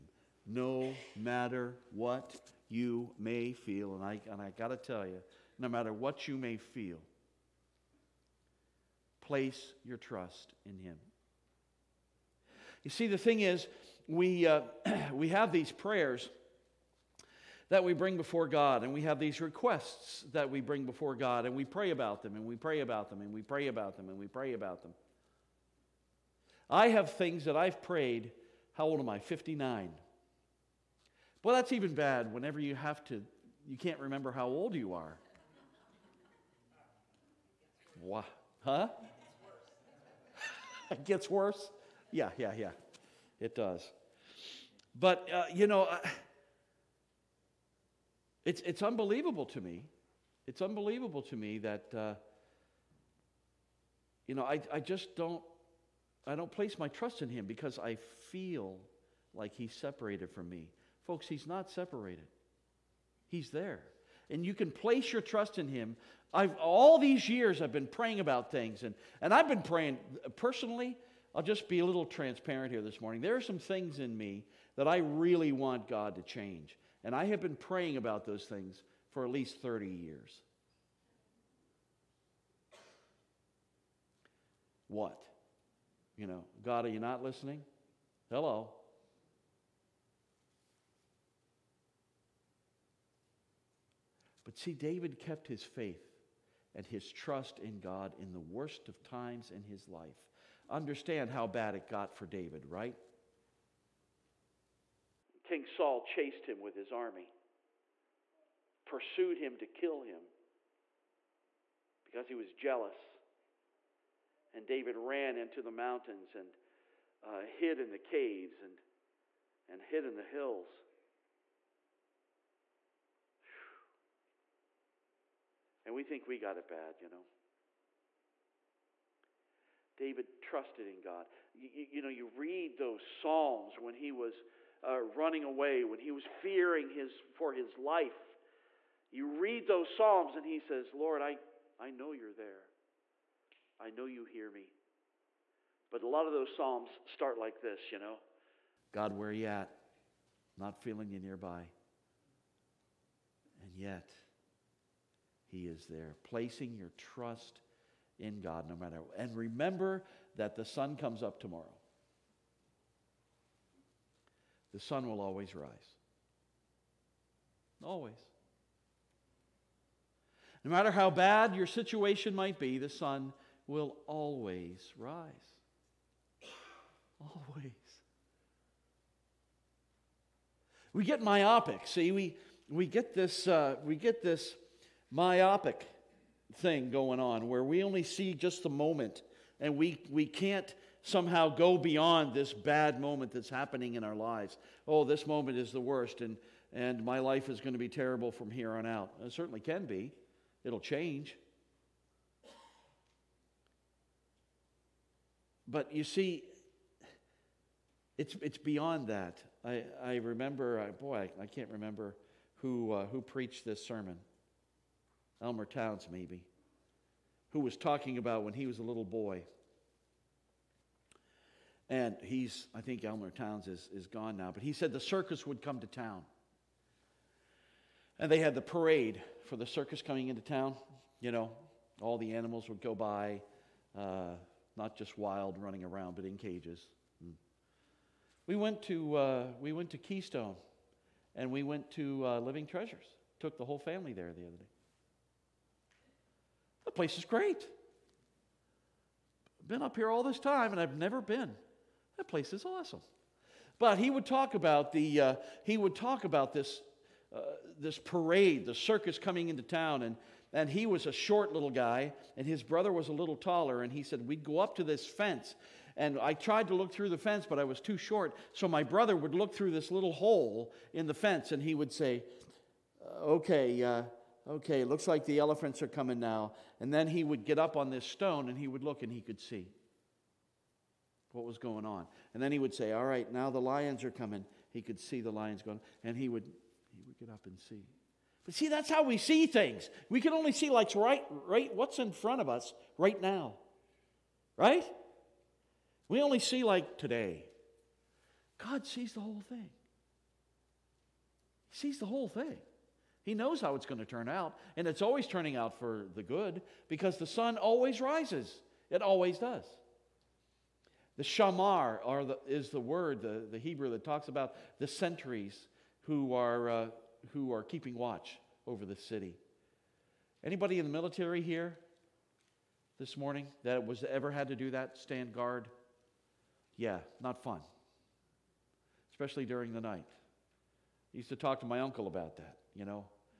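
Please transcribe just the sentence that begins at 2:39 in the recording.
And remember that the sun comes up tomorrow.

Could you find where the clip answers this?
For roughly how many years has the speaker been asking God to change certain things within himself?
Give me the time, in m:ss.
1:19.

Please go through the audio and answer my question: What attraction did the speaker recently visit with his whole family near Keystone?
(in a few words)
Living Treasures.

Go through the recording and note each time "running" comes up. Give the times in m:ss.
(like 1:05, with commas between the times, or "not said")
2:14, 3:55.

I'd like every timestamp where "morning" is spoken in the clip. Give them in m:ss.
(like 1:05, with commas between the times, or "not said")
1:12, 5:23.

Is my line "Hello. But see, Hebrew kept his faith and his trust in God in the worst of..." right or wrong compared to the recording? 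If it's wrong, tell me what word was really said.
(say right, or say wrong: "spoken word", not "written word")
wrong: "David", not "Hebrew".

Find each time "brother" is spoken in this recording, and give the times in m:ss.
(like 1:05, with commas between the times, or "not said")
4:22, 4:28.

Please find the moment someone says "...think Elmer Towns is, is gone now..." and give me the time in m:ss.
3:42.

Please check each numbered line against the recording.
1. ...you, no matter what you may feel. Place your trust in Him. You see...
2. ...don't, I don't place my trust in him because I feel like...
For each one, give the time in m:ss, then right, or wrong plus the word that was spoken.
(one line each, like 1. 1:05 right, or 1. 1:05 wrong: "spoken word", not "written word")
1. 0:05 right
2. 0:55 right.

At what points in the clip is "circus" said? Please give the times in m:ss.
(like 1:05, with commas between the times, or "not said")
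3:44, 3:49, 4:18.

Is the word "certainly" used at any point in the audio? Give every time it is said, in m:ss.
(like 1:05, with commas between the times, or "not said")
3:19.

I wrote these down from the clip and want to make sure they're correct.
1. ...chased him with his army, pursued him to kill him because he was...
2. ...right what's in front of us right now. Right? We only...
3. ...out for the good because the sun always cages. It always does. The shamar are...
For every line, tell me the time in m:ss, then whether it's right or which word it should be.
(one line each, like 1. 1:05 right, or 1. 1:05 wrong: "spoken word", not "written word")
1. 1:46 right
2. 4:51 right
3. 5:05 wrong: "rises", not "cages".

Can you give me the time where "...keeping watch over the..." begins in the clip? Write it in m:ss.
5:17.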